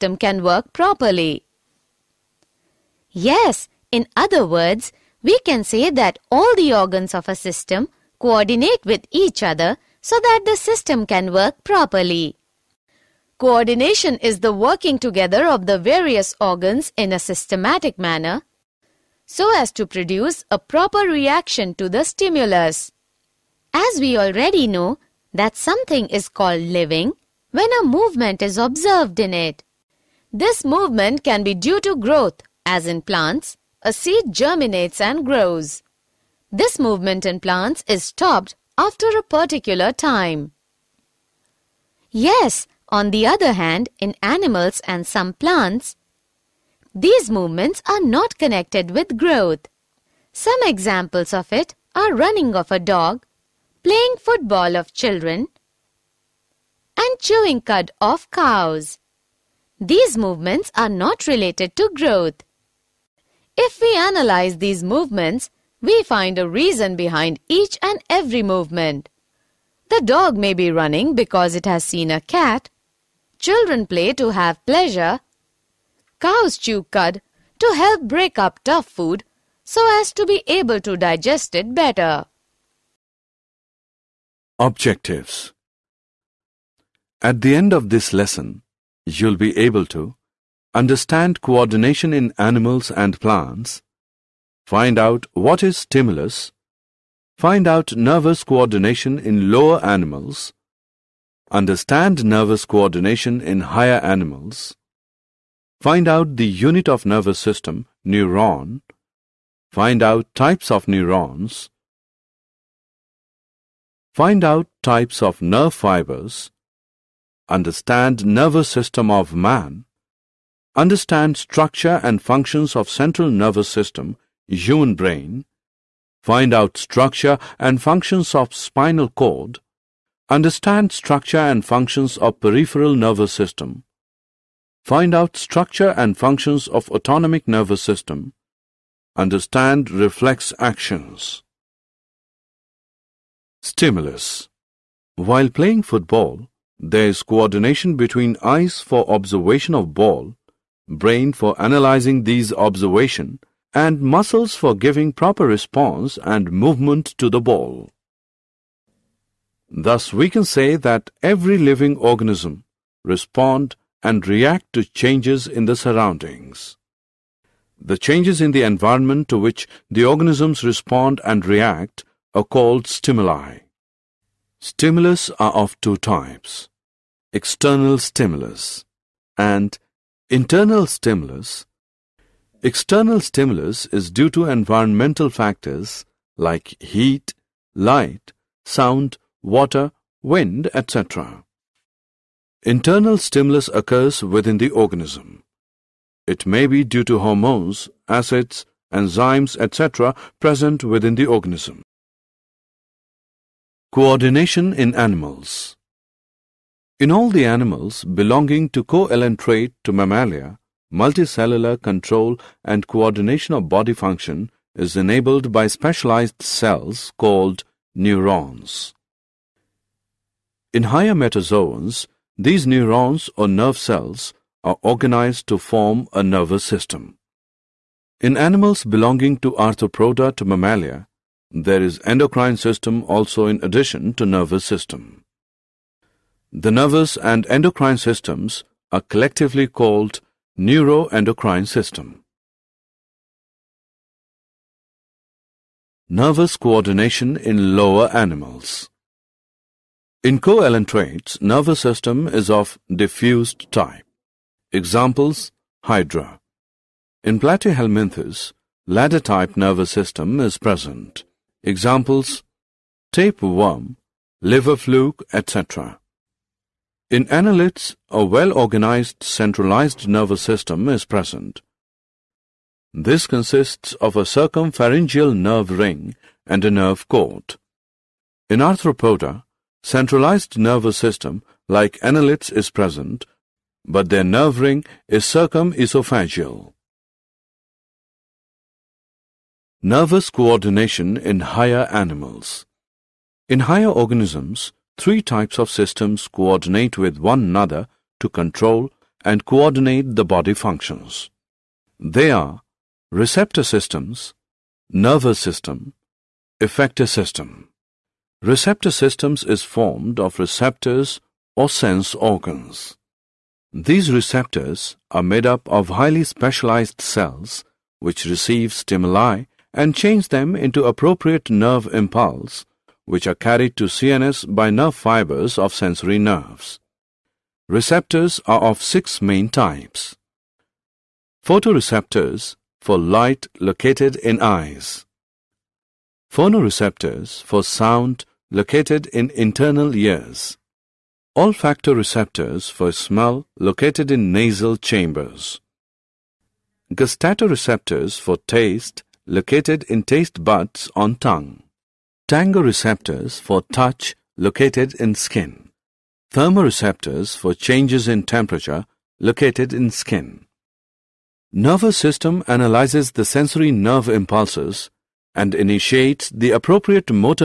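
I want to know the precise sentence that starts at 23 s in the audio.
As we already know that something is called living when a movement is observed in it.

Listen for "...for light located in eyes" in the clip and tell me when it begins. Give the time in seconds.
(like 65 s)
332 s.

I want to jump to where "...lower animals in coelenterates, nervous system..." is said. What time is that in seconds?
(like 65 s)
247 s.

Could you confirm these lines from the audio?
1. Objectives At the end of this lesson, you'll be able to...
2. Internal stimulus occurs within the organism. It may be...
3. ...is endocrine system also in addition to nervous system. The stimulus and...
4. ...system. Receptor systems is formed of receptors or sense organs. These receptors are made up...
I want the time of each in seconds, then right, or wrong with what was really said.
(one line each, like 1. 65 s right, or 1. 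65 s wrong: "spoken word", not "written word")
1. 84 s right
2. 192 s right
3. 231 s wrong: "nervous", not "stimulus"
4. 307 s right.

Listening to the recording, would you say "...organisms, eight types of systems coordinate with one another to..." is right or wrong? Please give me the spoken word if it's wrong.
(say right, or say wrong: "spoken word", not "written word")
wrong: "three", not "eight".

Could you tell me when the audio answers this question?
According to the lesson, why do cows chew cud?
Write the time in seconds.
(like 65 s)
78 s.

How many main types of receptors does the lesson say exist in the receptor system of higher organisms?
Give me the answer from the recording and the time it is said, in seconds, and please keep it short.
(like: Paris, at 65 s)
6, at 328 s.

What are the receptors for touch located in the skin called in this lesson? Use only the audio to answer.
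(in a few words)
Tangoreceptors.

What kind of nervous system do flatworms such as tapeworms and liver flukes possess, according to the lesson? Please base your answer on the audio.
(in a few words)
Ladder-type.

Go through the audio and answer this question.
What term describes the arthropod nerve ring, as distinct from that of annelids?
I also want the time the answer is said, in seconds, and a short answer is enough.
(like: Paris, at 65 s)
Circumesophageal, at 285 s.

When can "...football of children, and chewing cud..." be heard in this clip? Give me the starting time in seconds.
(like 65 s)
54 s.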